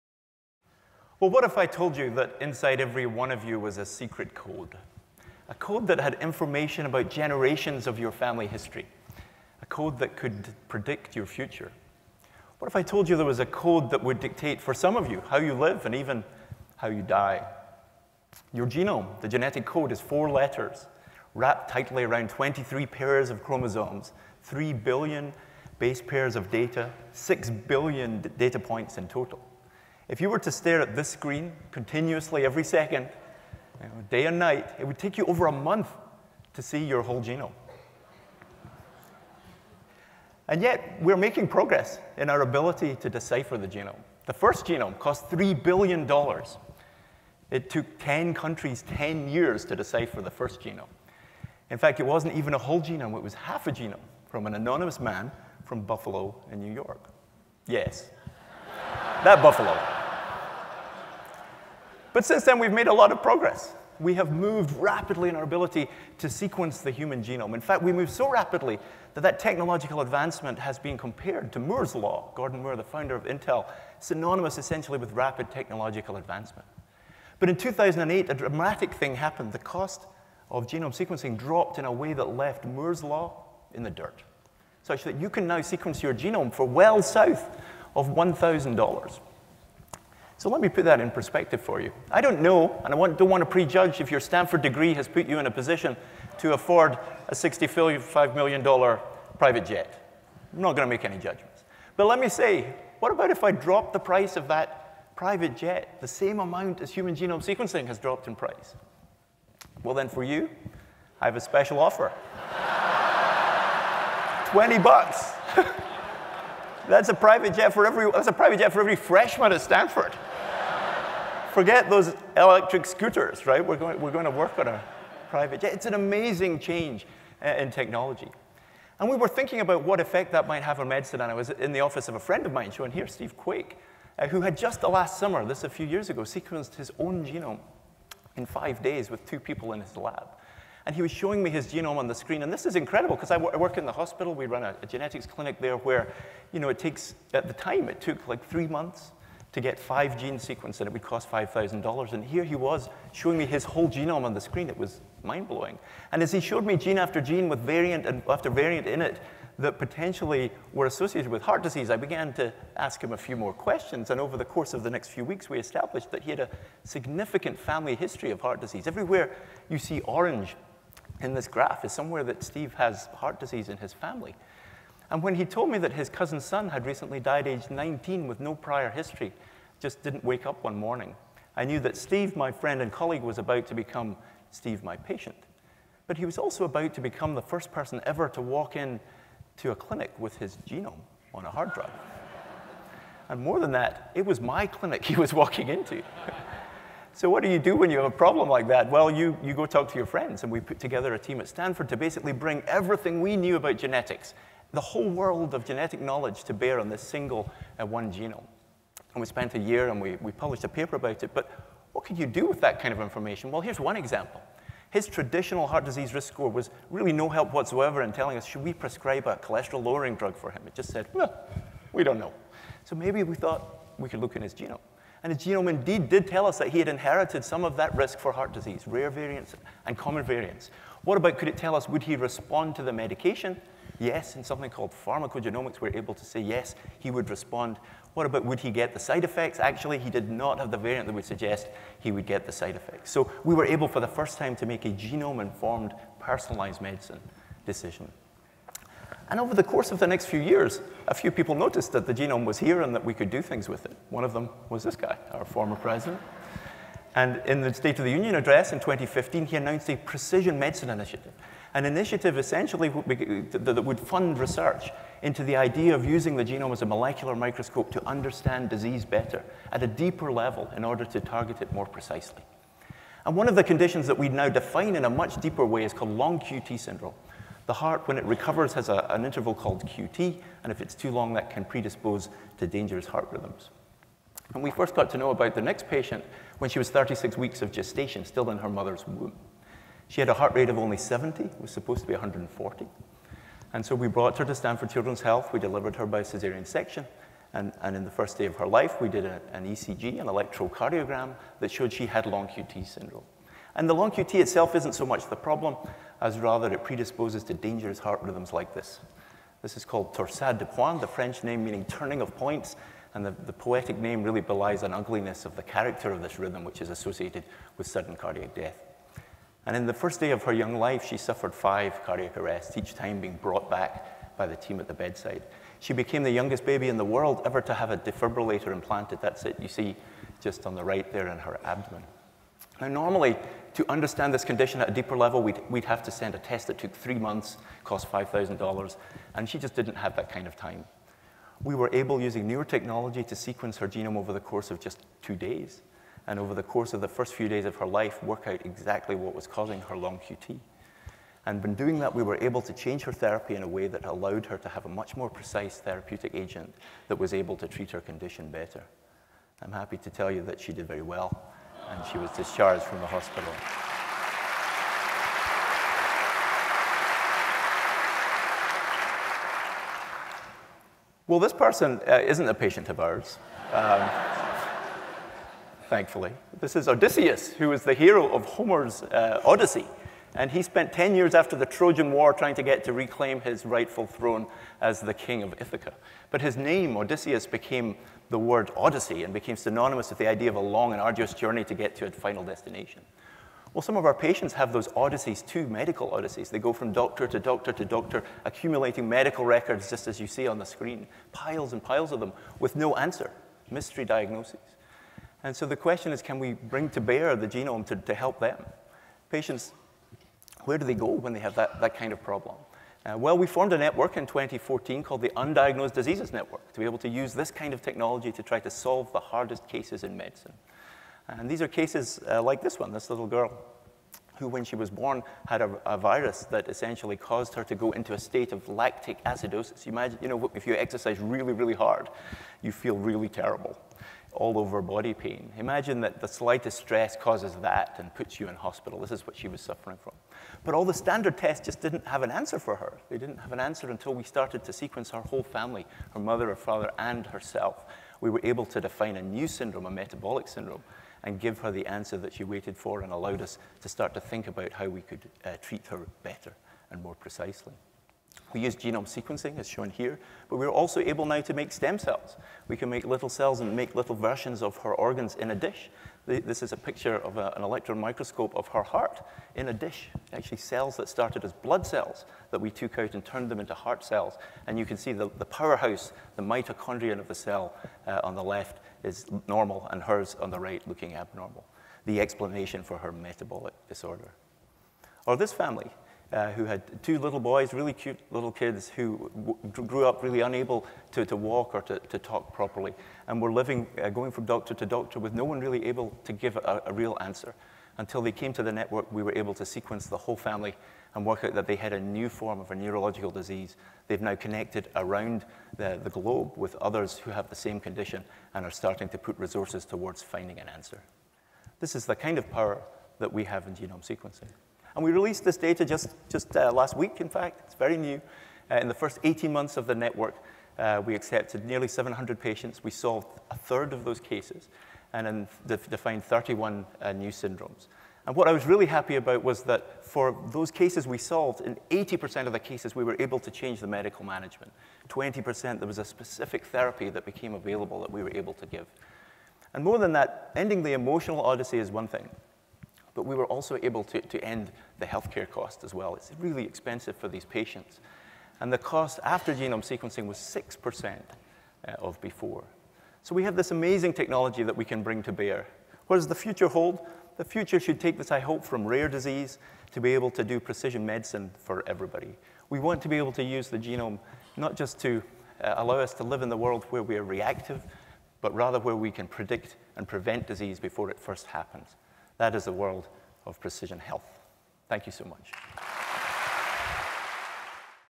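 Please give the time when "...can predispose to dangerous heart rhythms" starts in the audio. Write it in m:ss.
4:41.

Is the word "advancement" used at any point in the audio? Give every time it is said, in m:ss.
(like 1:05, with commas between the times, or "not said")
1:10, 1:16.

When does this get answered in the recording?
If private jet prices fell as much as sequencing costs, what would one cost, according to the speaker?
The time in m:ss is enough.
1:54.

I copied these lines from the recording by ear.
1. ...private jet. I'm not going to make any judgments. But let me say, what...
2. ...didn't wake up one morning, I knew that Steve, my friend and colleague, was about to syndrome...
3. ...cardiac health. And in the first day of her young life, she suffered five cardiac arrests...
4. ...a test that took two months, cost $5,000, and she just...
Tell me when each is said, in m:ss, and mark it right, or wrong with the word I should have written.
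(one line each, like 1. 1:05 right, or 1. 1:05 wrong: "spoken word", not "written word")
1. 1:39 right
2. 3:00 wrong: "become", not "syndrome"
3. 5:18 wrong: "death", not "health"
4. 5:36 wrong: "three", not "two".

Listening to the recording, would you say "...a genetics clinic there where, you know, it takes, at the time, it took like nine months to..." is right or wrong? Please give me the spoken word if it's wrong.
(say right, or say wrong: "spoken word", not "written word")
wrong: "three", not "nine".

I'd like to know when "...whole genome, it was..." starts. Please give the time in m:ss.
0:52.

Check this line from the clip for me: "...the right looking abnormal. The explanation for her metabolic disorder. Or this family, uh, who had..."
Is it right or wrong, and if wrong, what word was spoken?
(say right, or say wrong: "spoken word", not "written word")
right.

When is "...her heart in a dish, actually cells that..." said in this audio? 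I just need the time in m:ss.
7:48.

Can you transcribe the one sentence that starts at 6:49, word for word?
Patients, where do they go when they have that, that kind of problem?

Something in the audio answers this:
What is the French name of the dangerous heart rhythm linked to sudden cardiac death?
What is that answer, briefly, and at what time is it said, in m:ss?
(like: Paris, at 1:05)
torsade de pointe, at 5:10.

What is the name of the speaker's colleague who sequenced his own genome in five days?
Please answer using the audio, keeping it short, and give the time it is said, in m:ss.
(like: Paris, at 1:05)
Steve Quake, at 2:13.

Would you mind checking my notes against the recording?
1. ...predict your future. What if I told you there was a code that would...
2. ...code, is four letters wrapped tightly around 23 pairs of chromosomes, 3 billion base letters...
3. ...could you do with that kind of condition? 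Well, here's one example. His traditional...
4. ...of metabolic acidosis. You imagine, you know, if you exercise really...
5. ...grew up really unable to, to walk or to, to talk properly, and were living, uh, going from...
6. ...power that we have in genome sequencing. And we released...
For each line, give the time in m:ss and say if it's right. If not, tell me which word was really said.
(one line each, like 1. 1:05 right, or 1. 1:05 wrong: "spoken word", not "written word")
1. 0:10 right
2. 0:19 wrong: "pairs", not "letters"
3. 3:32 wrong: "information", not "condition"
4. 7:08 wrong: "lactic", not "metabolic"
5. 8:09 right
6. 8:32 right.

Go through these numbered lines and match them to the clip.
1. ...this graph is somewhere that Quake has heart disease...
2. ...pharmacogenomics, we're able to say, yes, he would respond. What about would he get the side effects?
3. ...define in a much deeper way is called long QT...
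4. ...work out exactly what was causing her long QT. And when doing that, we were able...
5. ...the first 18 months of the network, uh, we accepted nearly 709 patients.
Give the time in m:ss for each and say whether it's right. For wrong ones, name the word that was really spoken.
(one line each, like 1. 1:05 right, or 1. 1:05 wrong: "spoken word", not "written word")
1. 2:51 wrong: "Steve", not "Quake"
2. 3:55 right
3. 4:34 right
4. 5:48 right
5. 8:38 wrong: "700", not "709".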